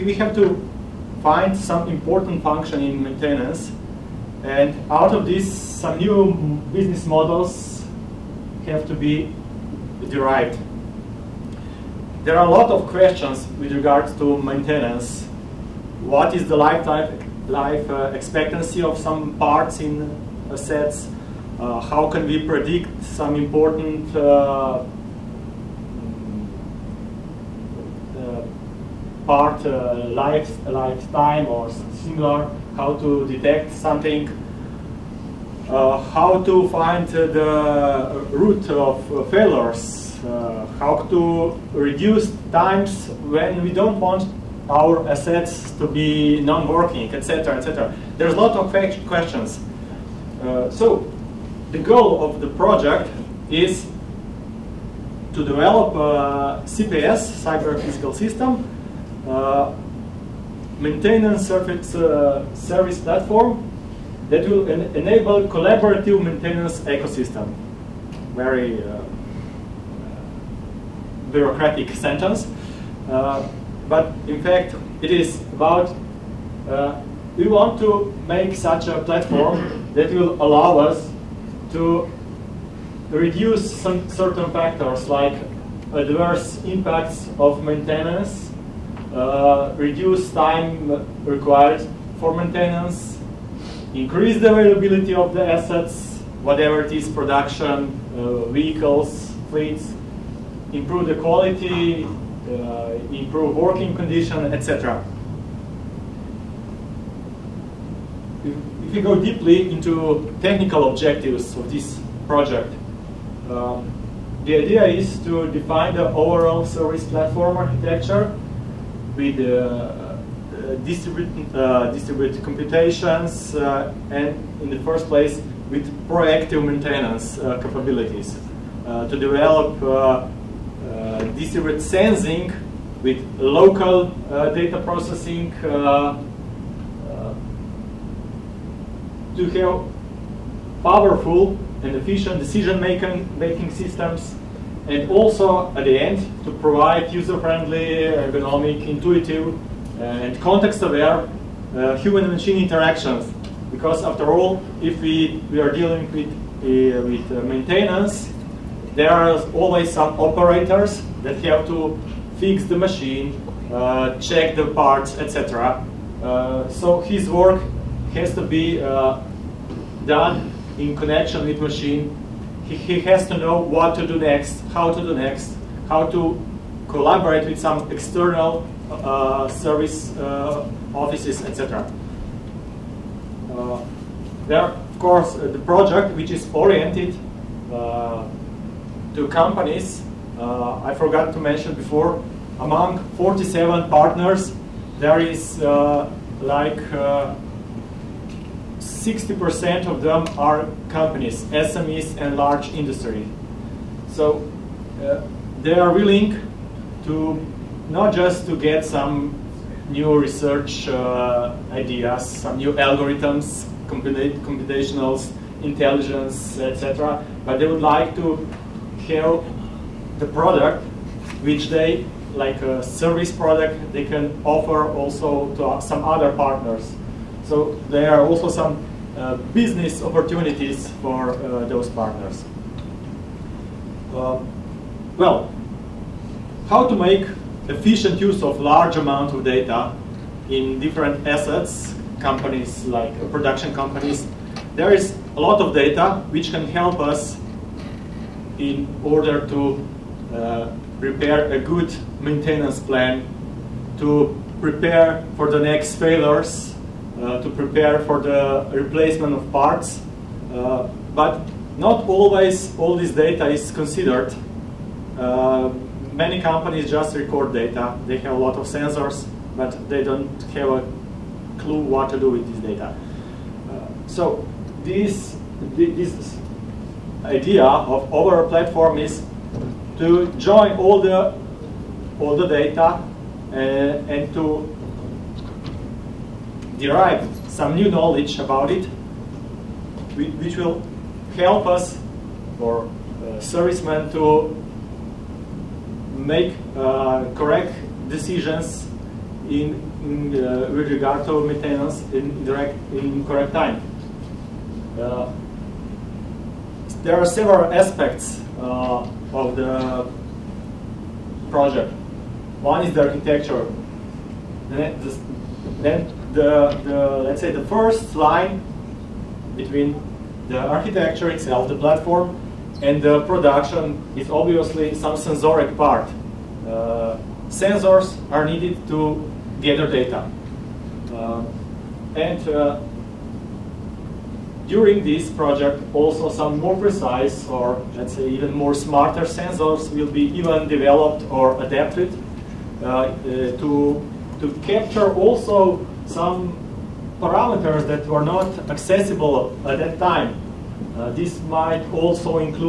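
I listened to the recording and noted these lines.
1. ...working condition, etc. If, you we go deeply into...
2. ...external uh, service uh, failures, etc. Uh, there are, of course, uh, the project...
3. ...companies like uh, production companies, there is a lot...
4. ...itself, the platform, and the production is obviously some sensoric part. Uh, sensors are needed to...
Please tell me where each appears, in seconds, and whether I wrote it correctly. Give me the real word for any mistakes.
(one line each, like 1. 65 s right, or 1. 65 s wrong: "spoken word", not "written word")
1. 103 s right
2. 177 s wrong: "offices", not "failures"
3. 242 s right
4. 321 s right.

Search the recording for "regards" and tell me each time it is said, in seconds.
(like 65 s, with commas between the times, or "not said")
13 s, 300 s.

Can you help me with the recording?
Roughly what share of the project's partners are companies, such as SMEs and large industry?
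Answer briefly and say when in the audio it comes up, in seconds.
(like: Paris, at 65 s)
60%, at 199 s.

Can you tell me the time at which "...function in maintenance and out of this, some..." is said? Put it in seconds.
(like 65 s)
2 s.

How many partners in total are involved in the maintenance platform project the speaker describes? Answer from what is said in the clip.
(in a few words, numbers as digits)
47.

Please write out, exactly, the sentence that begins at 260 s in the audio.
Uh, but not always all this data is considered.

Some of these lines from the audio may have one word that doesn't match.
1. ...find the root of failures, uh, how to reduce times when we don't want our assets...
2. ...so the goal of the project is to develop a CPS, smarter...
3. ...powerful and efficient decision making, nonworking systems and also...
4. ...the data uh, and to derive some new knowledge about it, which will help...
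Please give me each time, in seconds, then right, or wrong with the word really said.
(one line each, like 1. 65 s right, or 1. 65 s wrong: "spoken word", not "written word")
1. 36 s right
2. 50 s wrong: "cyber", not "smarter"
3. 140 s wrong: "making", not "nonworking"
4. 282 s right.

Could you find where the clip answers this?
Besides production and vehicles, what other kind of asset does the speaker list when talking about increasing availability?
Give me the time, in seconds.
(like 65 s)
99 s.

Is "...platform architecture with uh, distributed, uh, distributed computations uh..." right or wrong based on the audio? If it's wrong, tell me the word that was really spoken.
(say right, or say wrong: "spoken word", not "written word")
right.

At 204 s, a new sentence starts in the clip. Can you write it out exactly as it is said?
So uh, they are willing to not just to get some new research uh, ideas, some new algorithms, computationals, intelligence, etc.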